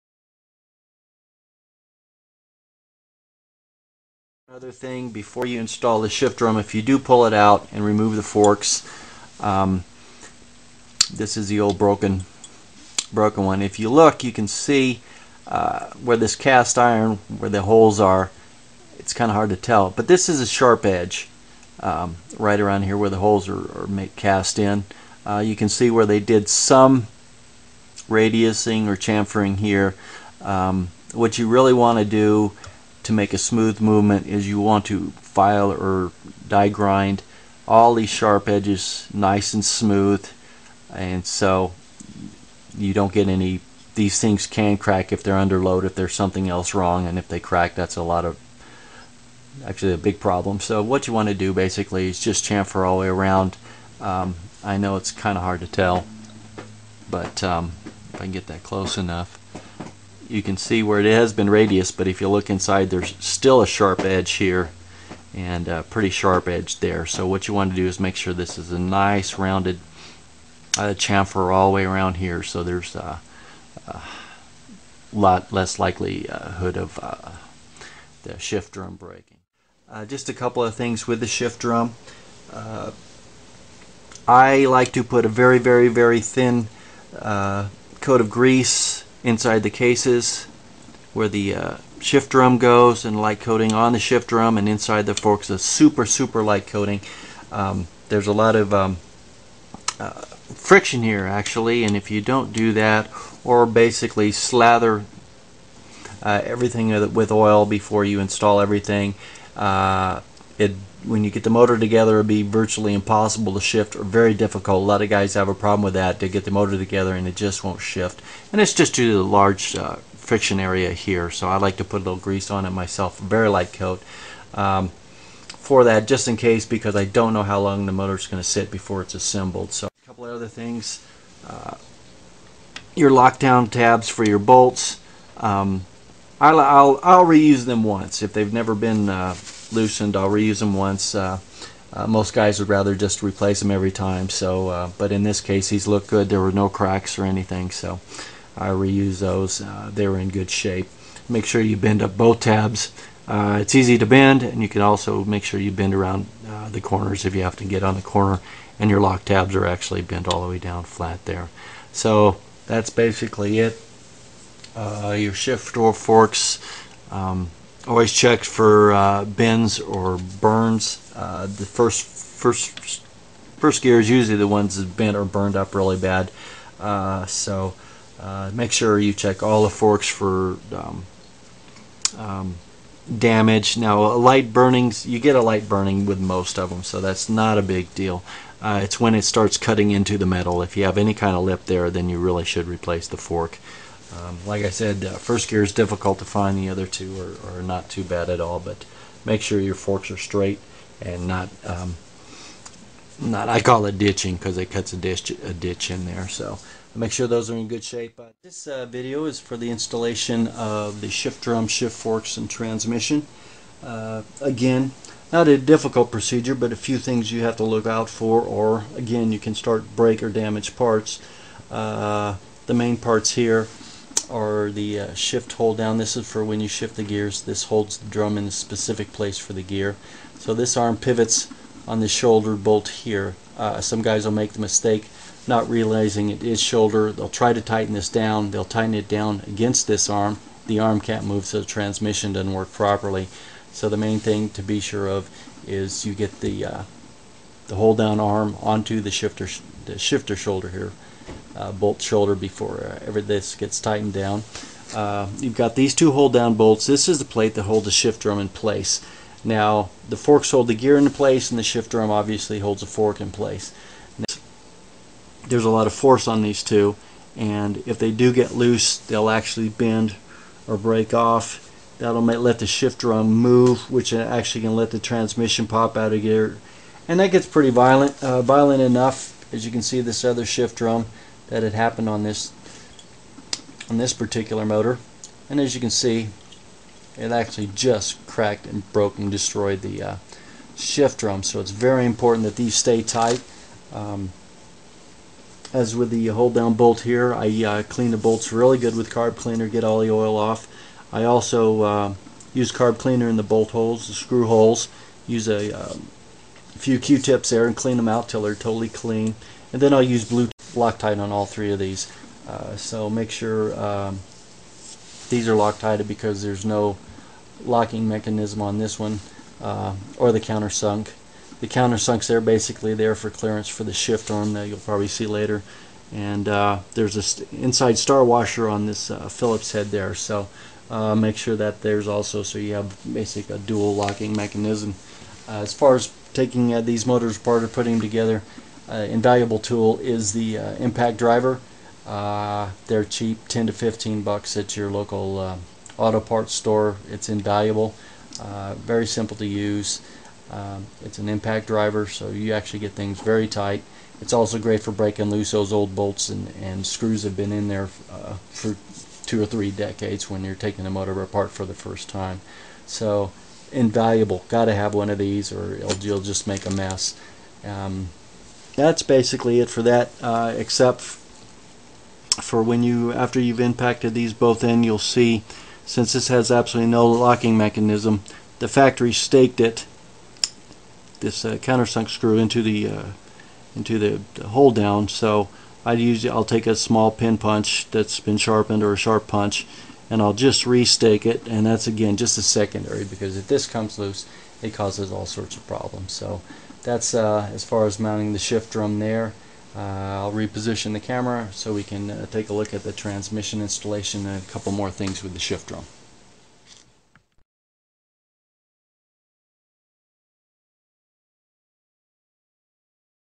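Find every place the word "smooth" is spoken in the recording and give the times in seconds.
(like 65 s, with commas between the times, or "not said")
33 s, 39 s.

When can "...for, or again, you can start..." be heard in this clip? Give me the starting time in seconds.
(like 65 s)
218 s.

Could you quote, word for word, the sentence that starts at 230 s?
So this arm pivots on the shoulder bolt here.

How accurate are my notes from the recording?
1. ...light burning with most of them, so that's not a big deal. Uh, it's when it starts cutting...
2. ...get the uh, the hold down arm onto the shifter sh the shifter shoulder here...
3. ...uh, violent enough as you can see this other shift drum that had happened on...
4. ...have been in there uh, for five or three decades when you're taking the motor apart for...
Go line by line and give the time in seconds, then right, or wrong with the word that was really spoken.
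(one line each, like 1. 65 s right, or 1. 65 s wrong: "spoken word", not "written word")
1. 185 s right
2. 246 s right
3. 278 s right
4. 357 s wrong: "two", not "five".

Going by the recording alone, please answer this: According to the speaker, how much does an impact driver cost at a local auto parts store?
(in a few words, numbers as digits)
10 to 15 bucks.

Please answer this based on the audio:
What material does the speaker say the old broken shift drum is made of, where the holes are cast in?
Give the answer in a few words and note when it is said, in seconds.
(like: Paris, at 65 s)
cast iron, at 16 s.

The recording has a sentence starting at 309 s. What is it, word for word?
And then I'll use blue Loctite on all three of these.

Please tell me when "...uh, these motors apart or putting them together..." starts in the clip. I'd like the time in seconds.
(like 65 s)
336 s.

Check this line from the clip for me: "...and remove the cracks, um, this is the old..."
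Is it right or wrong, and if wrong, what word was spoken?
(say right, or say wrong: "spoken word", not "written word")
wrong: "forks", not "cracks".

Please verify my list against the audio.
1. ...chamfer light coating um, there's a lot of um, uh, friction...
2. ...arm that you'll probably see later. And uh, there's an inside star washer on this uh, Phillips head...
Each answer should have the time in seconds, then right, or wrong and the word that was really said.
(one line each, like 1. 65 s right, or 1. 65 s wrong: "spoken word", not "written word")
1. 96 s wrong: "super", not "chamfer"
2. 324 s right.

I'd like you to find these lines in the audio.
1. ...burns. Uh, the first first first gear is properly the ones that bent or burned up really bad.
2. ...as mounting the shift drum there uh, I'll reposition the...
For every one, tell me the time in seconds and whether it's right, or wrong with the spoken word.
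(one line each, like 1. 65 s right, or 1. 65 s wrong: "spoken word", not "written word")
1. 170 s wrong: "usually", not "properly"
2. 397 s right.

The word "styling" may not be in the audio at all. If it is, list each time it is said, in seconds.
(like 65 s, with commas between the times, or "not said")
not said.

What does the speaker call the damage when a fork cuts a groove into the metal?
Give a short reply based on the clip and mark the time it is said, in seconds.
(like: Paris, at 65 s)
ditching, at 203 s.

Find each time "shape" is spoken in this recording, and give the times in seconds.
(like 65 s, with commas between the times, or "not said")
150 s, 207 s.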